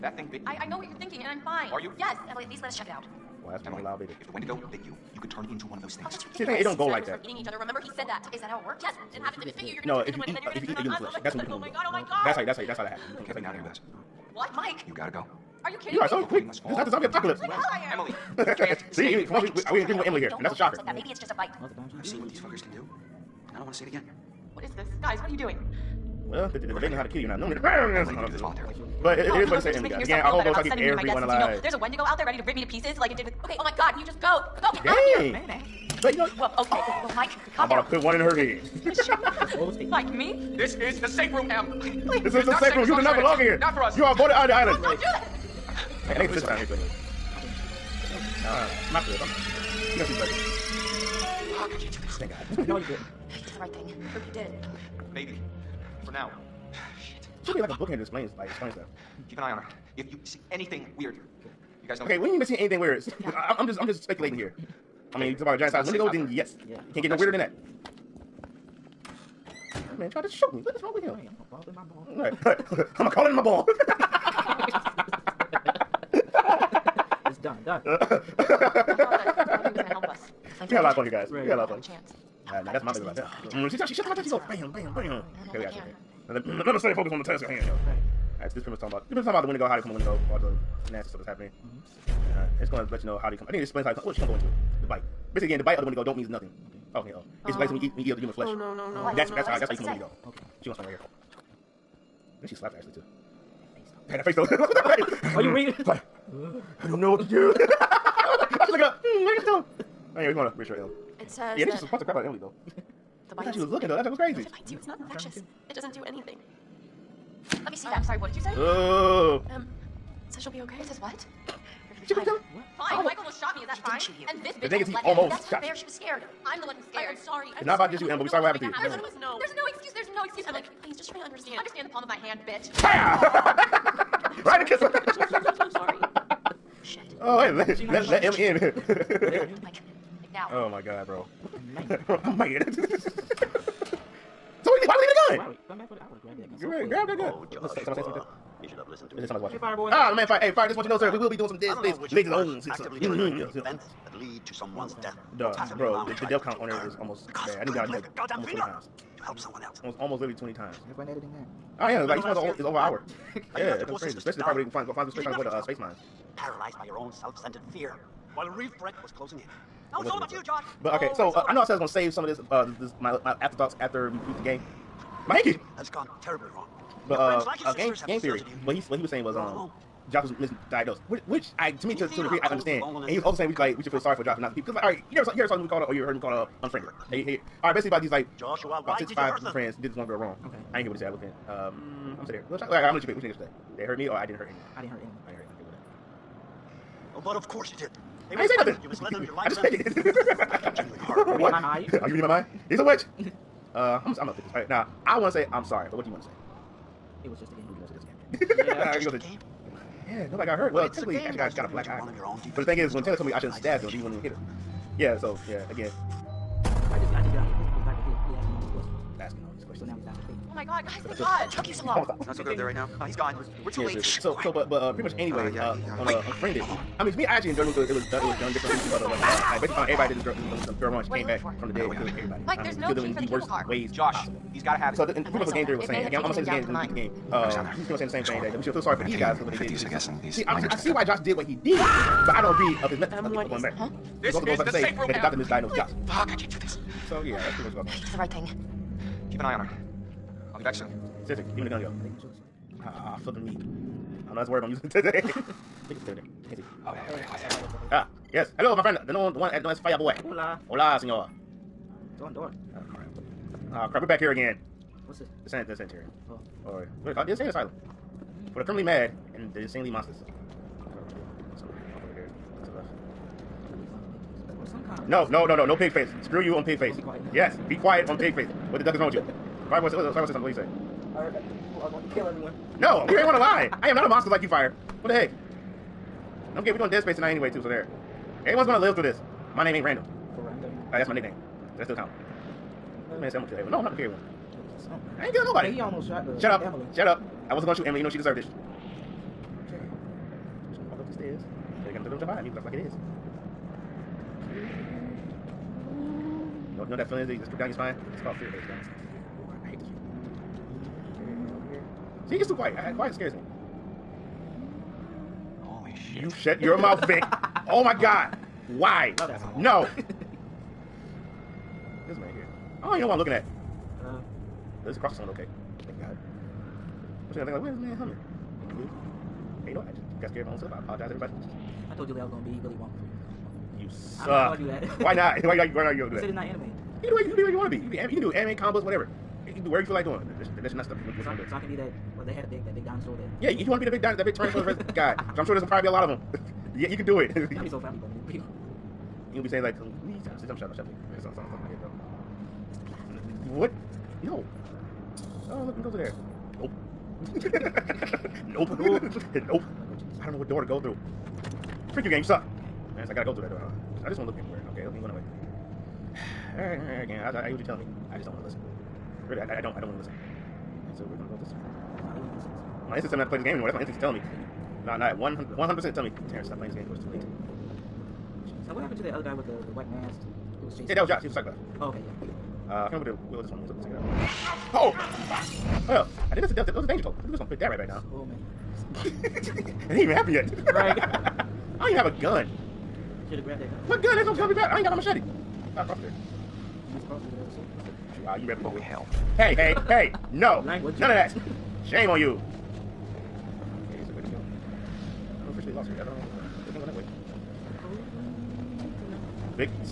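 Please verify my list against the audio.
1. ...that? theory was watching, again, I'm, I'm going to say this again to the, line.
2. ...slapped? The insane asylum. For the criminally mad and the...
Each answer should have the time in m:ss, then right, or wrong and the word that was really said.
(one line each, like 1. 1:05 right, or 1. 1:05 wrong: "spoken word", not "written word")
1. 3:55 wrong: "saying", not "watching"
2. 4:27 wrong: "called", not "slapped".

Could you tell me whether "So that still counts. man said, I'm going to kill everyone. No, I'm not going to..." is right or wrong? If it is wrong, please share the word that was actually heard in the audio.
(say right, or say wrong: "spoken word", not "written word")
right.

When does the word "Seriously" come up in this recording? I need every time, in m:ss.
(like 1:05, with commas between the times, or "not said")
3:43, 4:11.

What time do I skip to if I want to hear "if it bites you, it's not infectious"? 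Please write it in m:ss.
1:54.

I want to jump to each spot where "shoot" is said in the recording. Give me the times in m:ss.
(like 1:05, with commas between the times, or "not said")
1:10, 2:04, 4:57.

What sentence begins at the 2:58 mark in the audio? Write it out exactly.
What he what he was saying was um, Josh was misdiagnosed, which, which I to me to to a degree I understand.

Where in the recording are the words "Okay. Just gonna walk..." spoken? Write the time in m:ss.
4:59.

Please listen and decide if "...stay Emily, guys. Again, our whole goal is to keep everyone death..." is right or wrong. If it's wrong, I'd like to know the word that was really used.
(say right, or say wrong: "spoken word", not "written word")
right.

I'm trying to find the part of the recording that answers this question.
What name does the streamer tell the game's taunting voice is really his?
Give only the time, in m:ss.
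6:16.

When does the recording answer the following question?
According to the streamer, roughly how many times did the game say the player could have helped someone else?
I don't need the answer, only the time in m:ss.
2:38.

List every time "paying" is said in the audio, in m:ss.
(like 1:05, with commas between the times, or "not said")
3:11.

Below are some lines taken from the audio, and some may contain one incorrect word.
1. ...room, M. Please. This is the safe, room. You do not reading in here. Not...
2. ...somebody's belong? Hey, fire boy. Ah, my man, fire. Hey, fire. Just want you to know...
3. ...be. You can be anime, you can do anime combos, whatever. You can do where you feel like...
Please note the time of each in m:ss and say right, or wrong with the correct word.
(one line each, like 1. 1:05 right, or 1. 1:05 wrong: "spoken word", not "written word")
1. 0:41 wrong: "belong", not "reading"
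2. 2:29 wrong: "watching", not "belong"
3. 5:37 right.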